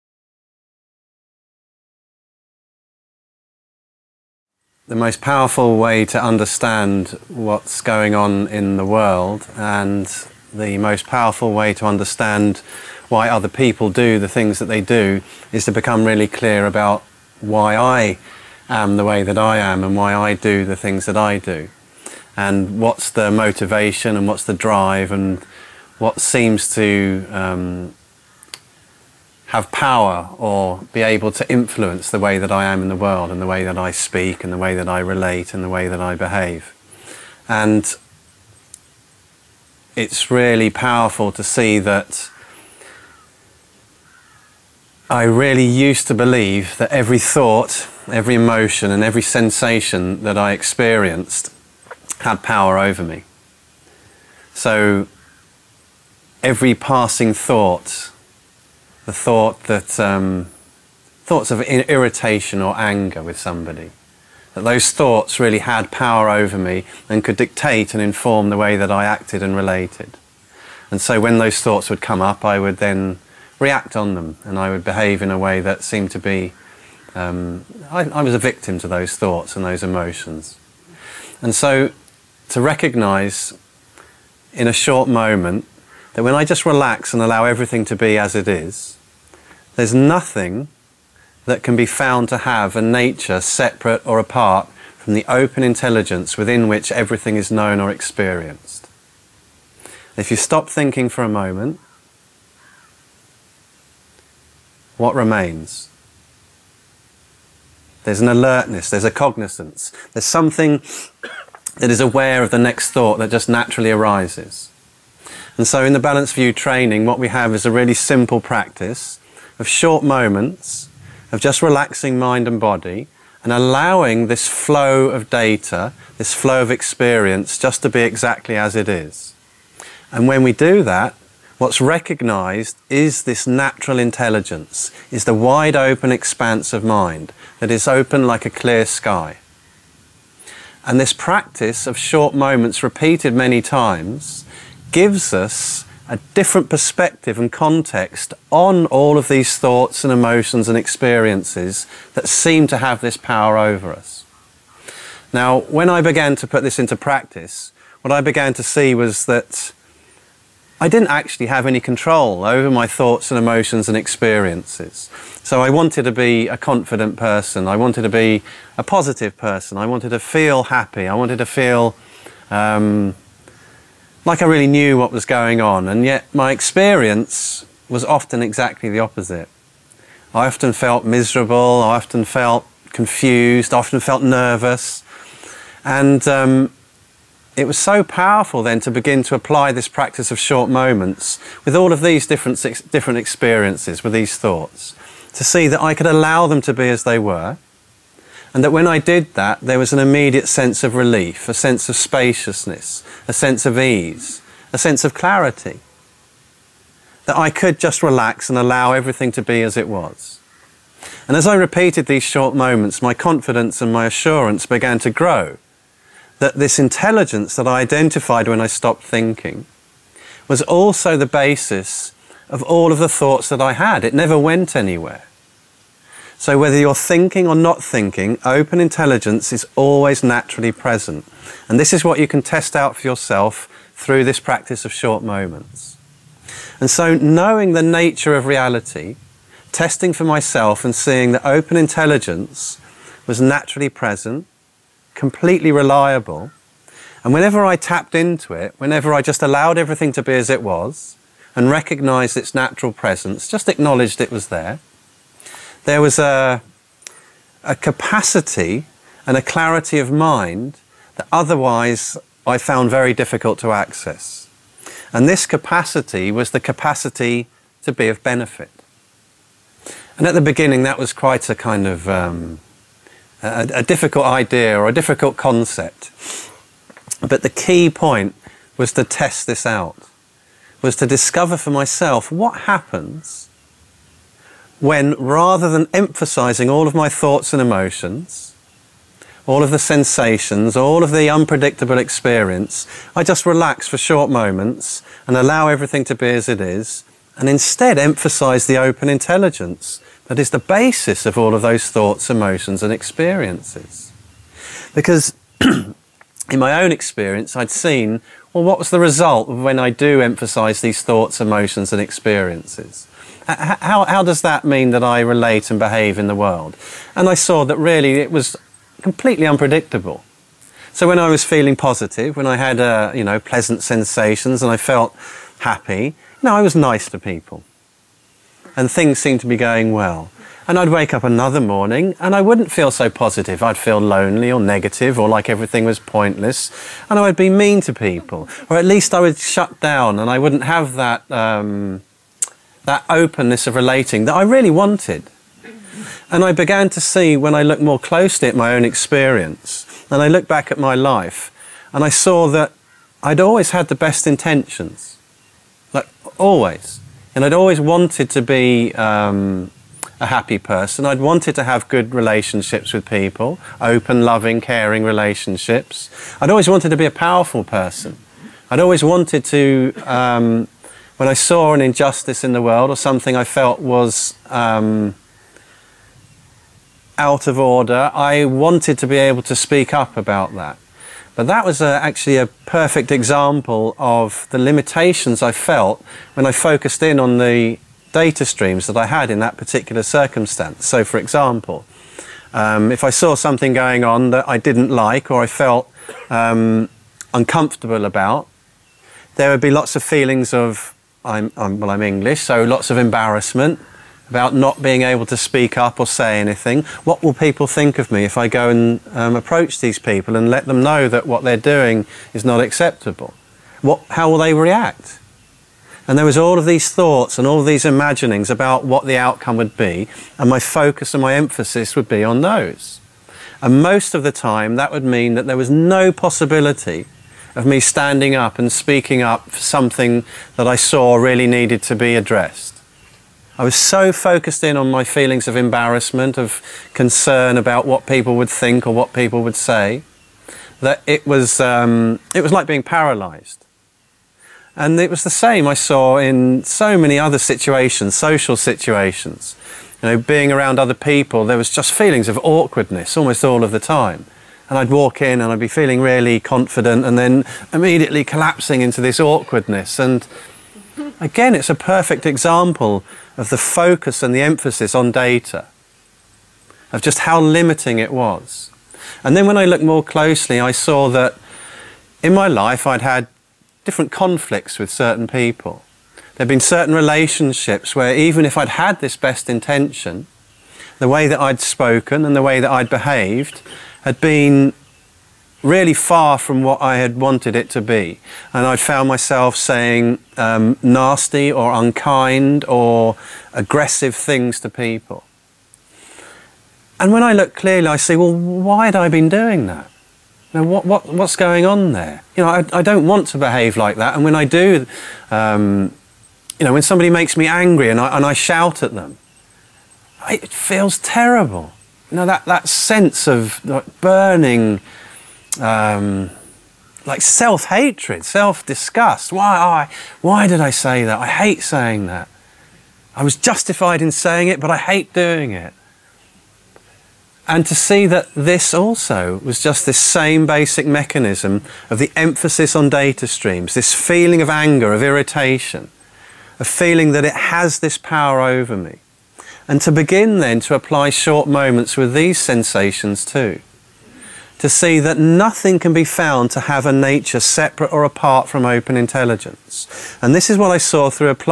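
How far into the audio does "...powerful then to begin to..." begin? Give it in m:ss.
3:08.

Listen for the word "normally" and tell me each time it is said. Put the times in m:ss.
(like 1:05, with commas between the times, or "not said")
not said.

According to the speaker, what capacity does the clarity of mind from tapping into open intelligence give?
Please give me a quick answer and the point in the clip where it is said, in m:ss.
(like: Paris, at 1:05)
be of benefit, at 4:27.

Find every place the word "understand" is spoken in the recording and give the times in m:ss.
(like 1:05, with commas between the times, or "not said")
0:06, 0:11.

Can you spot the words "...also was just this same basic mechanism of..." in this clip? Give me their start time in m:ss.
8:48.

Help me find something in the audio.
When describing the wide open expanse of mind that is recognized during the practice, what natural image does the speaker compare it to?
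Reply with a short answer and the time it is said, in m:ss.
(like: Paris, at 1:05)
a clear sky, at 2:18.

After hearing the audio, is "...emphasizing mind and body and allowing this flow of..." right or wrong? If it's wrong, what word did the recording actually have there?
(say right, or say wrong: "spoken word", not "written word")
wrong: "relaxing", not "emphasizing".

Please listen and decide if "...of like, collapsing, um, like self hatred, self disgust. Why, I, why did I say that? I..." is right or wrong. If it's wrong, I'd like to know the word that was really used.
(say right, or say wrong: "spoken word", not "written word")
wrong: "burning", not "collapsing".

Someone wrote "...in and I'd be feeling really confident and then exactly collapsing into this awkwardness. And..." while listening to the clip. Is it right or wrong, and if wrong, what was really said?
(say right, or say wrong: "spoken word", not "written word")
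wrong: "immediately", not "exactly".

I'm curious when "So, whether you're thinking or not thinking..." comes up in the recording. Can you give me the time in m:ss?
3:46.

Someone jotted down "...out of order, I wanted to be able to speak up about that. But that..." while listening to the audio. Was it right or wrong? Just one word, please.
right.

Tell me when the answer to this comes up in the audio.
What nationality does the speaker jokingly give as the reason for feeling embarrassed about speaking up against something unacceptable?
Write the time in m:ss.
6:42.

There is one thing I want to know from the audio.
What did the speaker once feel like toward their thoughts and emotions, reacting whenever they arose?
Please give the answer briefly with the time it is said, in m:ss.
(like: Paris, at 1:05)
a victim, at 1:18.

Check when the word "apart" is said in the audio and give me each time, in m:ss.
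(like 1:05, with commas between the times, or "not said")
1:34, 9:08.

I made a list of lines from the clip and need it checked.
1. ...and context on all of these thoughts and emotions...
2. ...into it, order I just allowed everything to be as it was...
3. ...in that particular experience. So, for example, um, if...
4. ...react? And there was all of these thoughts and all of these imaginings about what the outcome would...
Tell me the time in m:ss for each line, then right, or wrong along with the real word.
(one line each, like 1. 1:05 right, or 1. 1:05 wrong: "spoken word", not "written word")
1. 2:27 right
2. 4:08 wrong: "whenever", not "order"
3. 6:29 wrong: "circumstance", not "experience"
4. 6:54 right.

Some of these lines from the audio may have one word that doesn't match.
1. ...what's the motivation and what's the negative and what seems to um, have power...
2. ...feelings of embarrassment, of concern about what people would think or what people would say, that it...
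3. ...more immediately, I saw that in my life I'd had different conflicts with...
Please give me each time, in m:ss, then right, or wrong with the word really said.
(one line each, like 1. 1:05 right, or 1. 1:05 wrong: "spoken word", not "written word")
1. 0:22 wrong: "drive", not "negative"
2. 7:15 right
3. 7:49 wrong: "closely", not "immediately".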